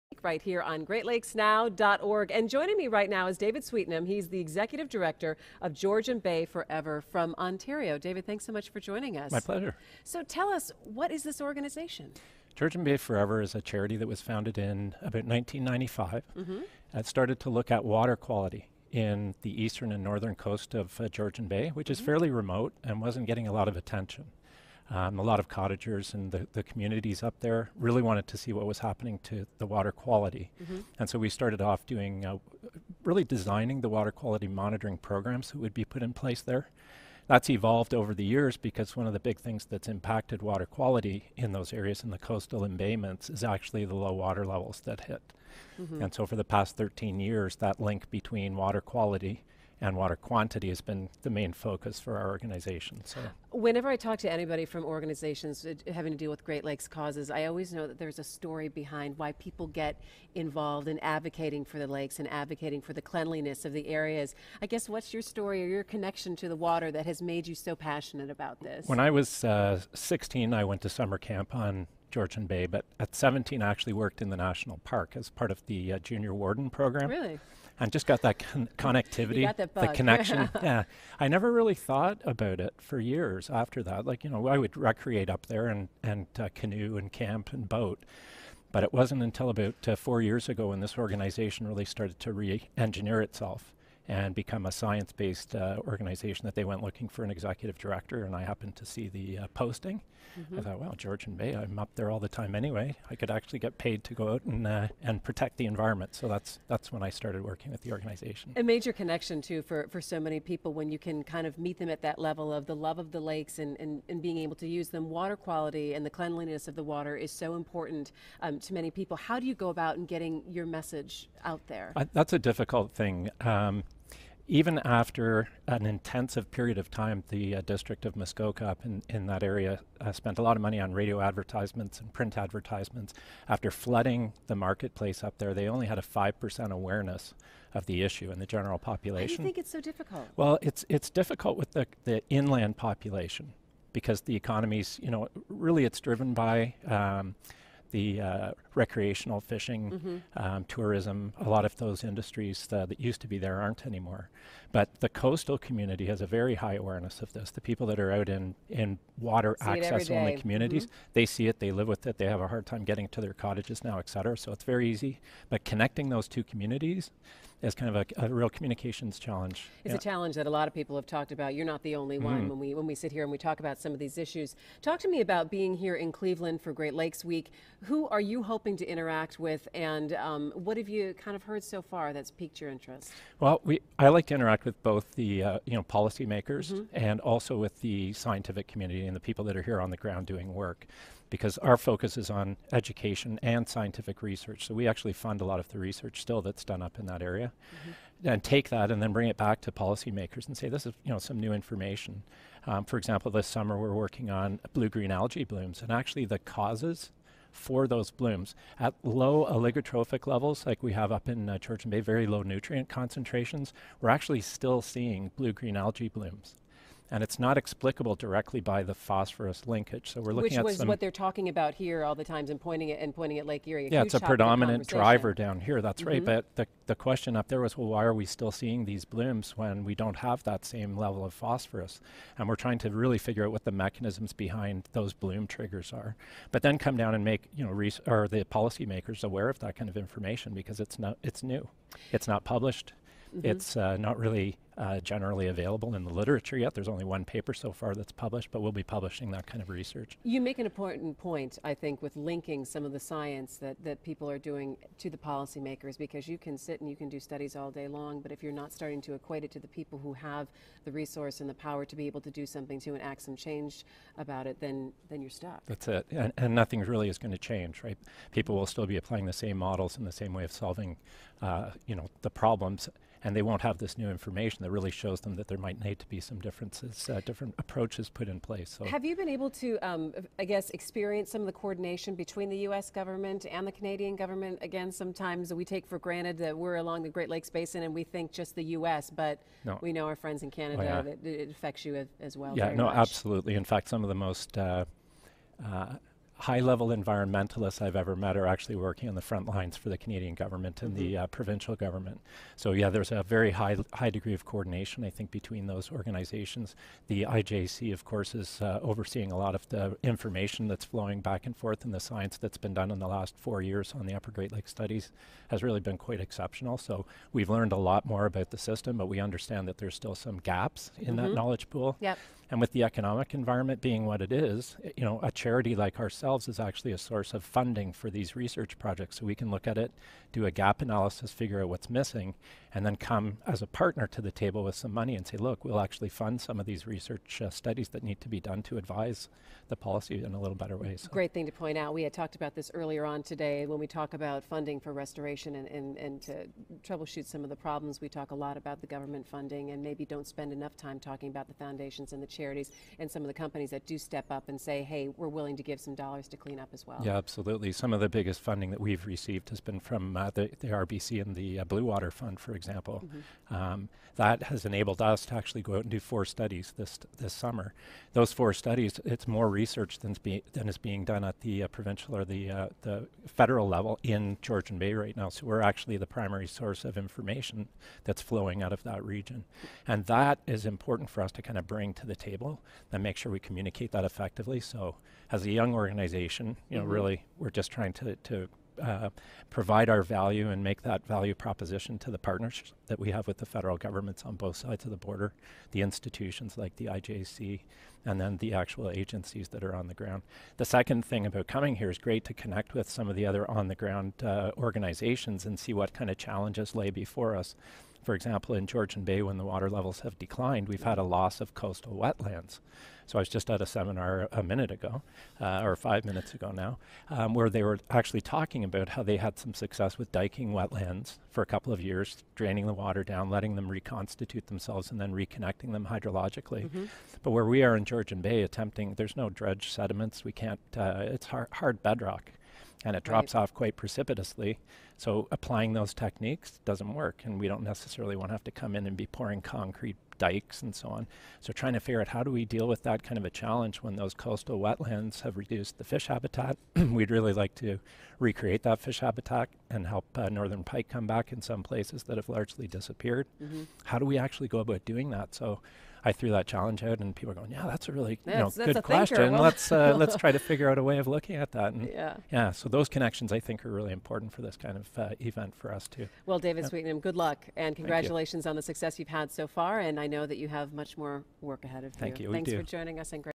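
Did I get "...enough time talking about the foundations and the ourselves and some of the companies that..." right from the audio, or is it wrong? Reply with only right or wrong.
wrong.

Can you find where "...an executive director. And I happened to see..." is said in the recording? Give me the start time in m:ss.
1:37.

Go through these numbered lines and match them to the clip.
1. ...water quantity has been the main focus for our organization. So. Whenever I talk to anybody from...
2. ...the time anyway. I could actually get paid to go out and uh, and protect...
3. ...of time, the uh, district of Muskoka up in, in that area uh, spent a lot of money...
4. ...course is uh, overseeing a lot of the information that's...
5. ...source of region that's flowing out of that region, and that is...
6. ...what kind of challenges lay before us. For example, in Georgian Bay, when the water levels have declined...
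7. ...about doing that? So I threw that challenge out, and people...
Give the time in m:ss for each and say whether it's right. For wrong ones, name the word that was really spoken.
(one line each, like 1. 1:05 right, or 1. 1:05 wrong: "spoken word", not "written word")
1. 0:49 right
2. 1:42 right
3. 2:06 right
4. 5:08 right
5. 6:16 wrong: "information", not "region"
6. 6:45 right
7. 7:34 right.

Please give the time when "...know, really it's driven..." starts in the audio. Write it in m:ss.
2:25.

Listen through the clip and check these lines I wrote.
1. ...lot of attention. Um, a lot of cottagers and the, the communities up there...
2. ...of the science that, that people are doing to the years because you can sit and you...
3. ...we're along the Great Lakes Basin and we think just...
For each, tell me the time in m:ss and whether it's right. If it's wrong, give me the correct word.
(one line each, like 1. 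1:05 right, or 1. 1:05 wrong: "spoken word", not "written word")
1. 0:23 right
2. 4:12 wrong: "policymakers", not "years"
3. 4:46 right.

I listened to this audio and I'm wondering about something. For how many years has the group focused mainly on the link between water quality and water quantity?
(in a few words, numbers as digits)
13.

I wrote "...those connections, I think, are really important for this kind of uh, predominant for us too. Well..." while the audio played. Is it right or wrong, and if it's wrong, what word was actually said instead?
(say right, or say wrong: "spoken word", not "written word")
wrong: "event", not "predominant".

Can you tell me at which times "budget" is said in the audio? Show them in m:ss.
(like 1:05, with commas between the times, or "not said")
not said.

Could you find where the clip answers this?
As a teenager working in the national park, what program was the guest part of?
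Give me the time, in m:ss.
1:15.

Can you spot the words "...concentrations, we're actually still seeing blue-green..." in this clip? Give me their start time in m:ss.
3:32.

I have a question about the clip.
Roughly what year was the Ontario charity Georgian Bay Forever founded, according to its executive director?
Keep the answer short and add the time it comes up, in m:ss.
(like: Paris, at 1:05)
1995, at 0:15.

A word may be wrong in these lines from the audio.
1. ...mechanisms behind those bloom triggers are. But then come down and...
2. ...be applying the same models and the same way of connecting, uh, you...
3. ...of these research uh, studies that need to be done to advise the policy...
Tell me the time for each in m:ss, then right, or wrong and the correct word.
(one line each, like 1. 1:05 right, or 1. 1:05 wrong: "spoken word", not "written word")
1. 3:53 right
2. 4:28 wrong: "solving", not "connecting"
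3. 5:36 right.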